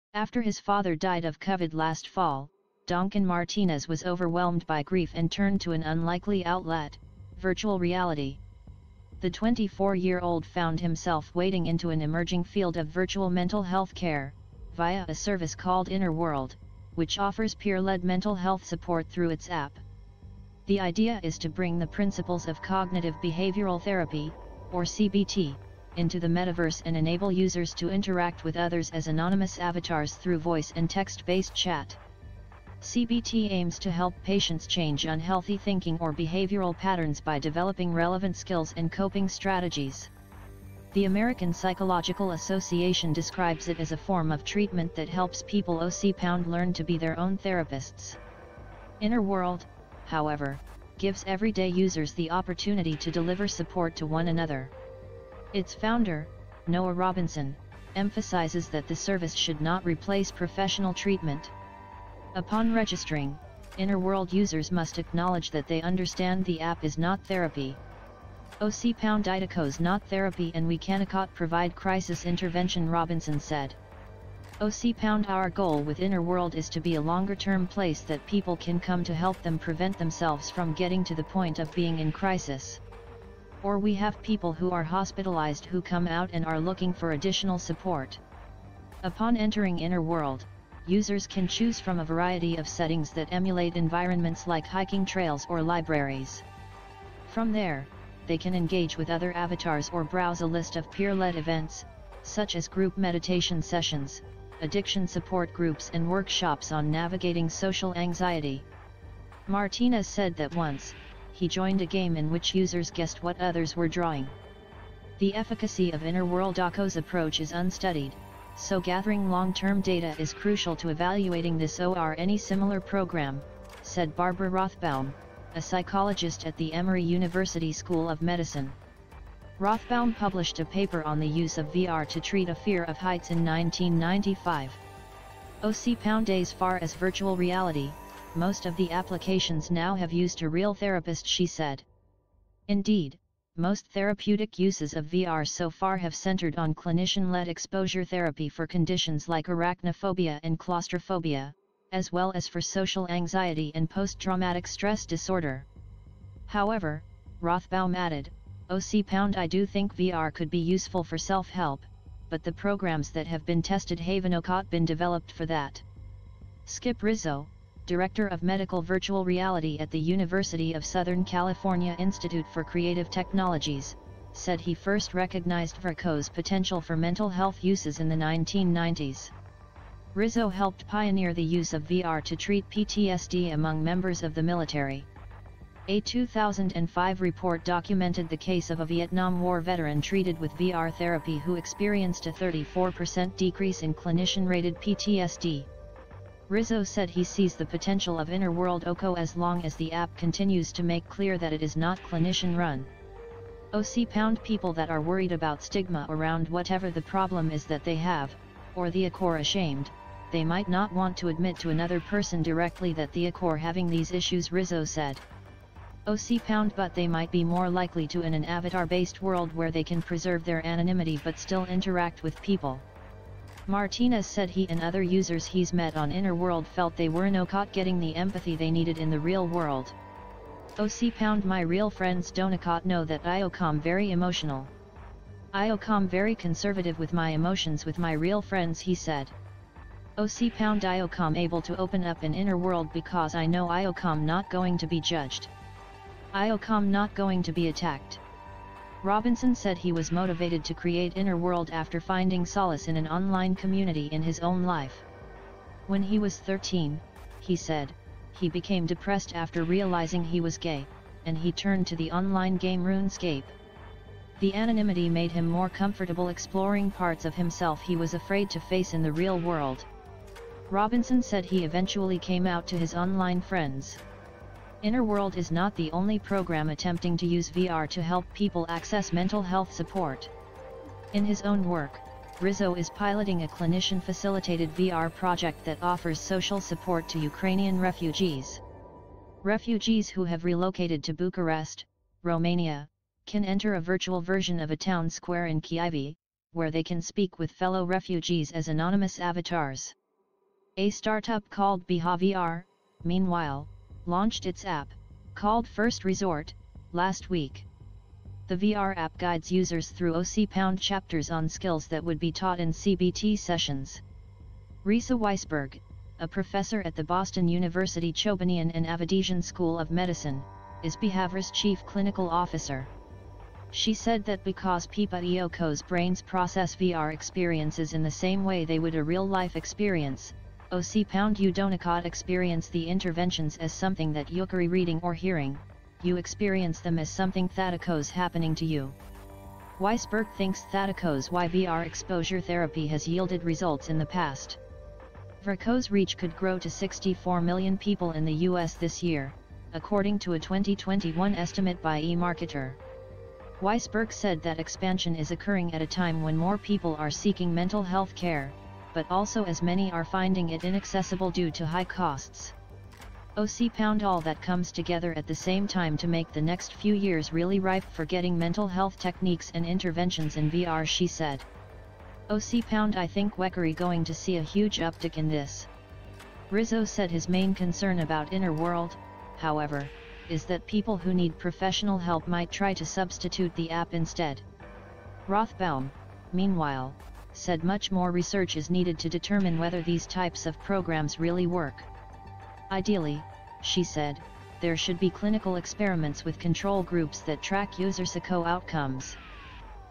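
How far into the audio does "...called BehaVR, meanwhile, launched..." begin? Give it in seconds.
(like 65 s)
301 s.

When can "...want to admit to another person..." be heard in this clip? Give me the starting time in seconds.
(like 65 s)
210 s.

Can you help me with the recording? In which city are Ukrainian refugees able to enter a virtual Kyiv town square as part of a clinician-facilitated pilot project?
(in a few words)
Bucharest.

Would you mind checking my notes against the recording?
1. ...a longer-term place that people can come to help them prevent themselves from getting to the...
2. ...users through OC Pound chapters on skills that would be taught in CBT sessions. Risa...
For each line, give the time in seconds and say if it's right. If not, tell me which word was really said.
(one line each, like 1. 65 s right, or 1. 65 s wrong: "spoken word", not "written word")
1. 76 s right
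2. 309 s right.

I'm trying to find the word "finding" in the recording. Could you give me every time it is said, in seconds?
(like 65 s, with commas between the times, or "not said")
251 s, 360 s.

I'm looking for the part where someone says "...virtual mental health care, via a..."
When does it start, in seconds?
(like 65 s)
12 s.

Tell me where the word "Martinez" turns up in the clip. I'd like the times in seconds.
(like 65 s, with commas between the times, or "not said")
3 s, 109 s, 223 s.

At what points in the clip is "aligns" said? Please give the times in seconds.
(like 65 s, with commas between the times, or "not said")
not said.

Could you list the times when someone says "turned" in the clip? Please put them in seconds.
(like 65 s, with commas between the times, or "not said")
5 s, 261 s.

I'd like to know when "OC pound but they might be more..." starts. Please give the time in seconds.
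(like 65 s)
216 s.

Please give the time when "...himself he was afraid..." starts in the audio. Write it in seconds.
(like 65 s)
267 s.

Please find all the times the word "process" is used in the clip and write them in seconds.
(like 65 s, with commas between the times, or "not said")
326 s.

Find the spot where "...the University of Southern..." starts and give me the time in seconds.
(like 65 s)
169 s.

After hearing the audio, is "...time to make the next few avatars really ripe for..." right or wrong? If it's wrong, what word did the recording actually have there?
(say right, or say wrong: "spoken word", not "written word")
wrong: "years", not "avatars".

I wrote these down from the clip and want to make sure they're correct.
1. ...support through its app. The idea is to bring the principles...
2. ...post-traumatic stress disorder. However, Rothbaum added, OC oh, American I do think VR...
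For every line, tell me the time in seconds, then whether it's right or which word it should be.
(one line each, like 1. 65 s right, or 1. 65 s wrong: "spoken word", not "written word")
1. 18 s right
2. 153 s wrong: "Pound", not "American".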